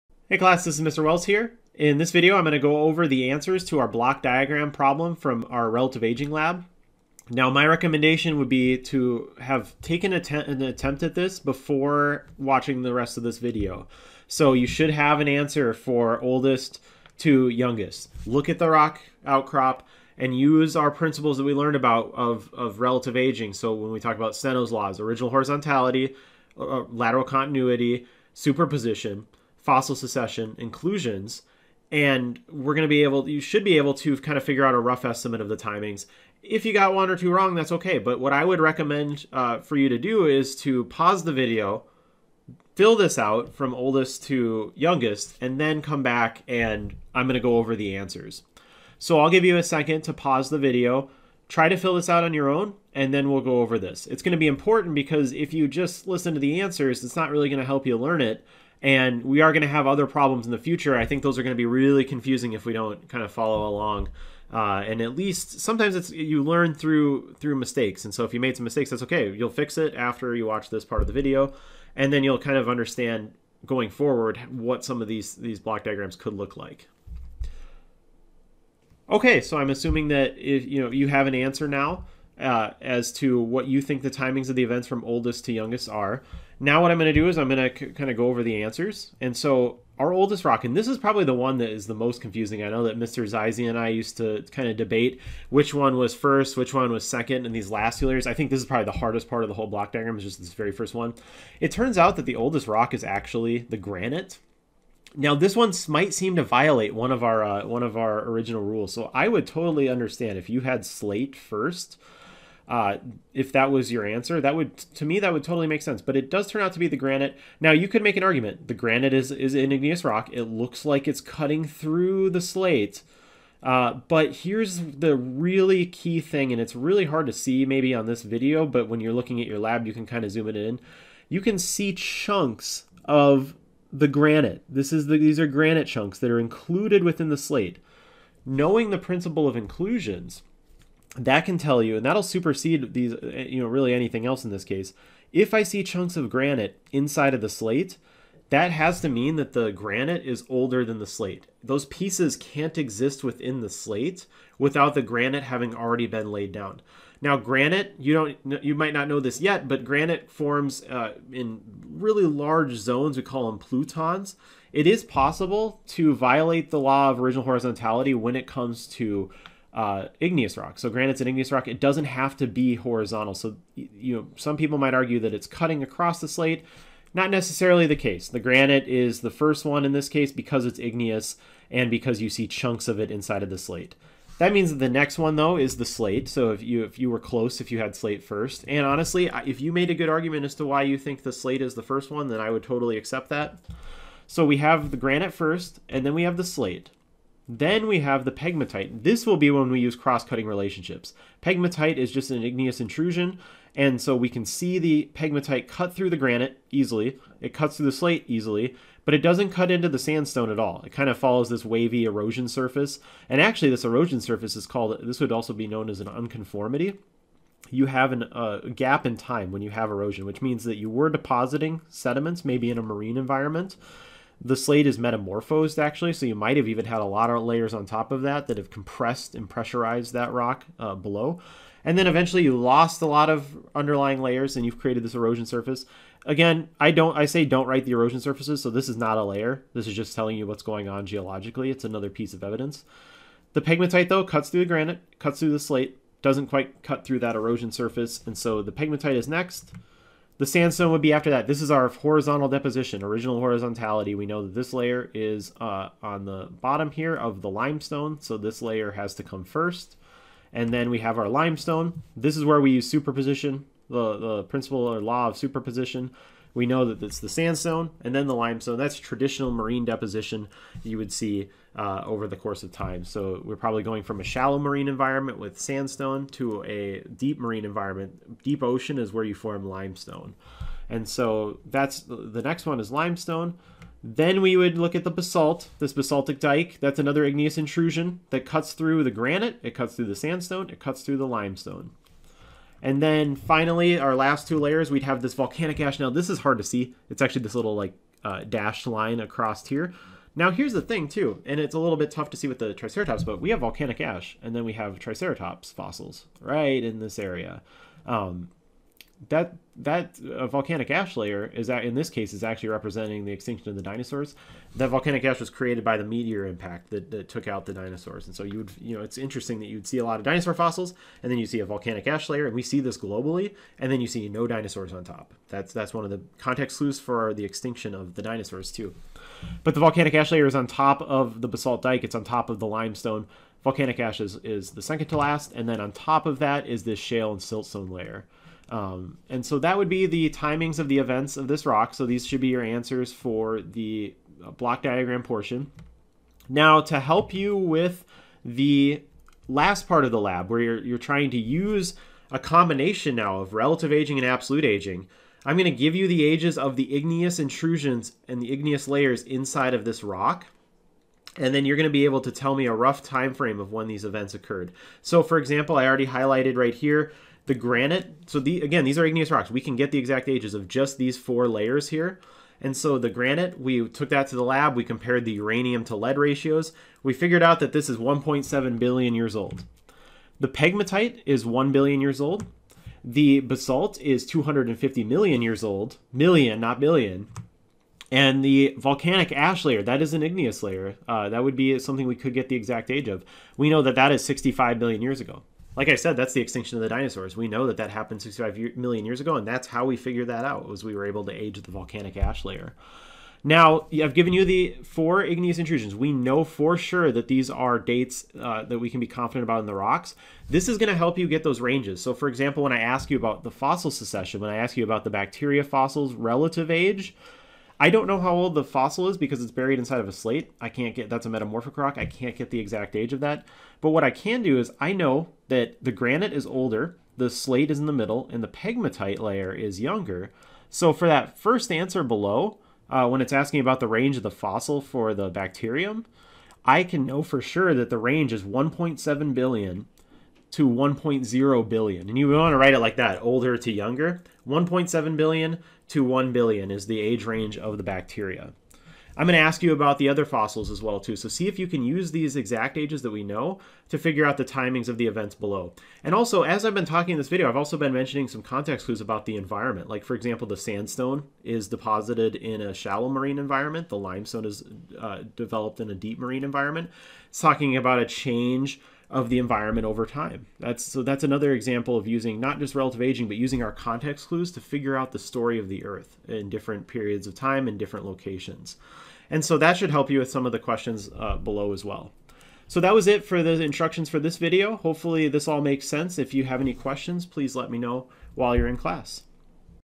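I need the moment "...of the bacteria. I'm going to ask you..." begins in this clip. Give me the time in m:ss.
7:27.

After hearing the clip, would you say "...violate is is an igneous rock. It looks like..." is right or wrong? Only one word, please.
wrong.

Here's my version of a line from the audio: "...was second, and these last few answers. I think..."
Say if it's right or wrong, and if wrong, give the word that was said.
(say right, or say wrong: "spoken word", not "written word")
wrong: "layers", not "answers".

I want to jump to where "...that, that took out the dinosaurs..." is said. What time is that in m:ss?
5:16.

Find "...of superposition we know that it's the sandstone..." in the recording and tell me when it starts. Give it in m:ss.
4:25.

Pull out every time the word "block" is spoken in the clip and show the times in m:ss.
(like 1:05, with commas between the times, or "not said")
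0:03, 1:15, 1:39, 5:44.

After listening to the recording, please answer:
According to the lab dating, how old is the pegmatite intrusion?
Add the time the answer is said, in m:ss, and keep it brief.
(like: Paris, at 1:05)
1 billion years, at 6:21.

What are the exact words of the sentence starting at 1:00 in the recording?
I think those are going to be really confusing if we don't kind of follow along.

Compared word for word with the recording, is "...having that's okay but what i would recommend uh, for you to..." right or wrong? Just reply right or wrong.
wrong.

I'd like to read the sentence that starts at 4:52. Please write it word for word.
And then finally, our last two layers, we'd have this volcanic ash.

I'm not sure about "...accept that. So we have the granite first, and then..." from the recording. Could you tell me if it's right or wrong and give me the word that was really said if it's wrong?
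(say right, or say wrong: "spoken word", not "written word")
right.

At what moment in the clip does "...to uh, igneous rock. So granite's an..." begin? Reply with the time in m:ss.
2:48.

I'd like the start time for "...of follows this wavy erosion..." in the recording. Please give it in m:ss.
3:31.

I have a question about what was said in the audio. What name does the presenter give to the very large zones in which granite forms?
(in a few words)
plutons.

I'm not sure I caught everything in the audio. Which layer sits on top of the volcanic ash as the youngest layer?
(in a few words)
shale and siltstone.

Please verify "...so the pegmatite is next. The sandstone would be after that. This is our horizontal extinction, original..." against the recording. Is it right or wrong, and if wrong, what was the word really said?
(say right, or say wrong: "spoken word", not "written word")
wrong: "deposition", not "extinction".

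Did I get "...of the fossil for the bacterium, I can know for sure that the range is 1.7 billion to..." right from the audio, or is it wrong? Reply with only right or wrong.
right.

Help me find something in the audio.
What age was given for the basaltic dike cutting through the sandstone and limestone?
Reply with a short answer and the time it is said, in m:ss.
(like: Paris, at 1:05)
250 million years, at 6:24.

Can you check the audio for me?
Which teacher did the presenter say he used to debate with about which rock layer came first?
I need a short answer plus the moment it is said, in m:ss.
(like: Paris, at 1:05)
Mr. Zizi, at 1:32.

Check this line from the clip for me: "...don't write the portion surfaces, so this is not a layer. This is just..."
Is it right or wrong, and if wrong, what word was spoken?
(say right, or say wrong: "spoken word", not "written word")
wrong: "erosion", not "portion".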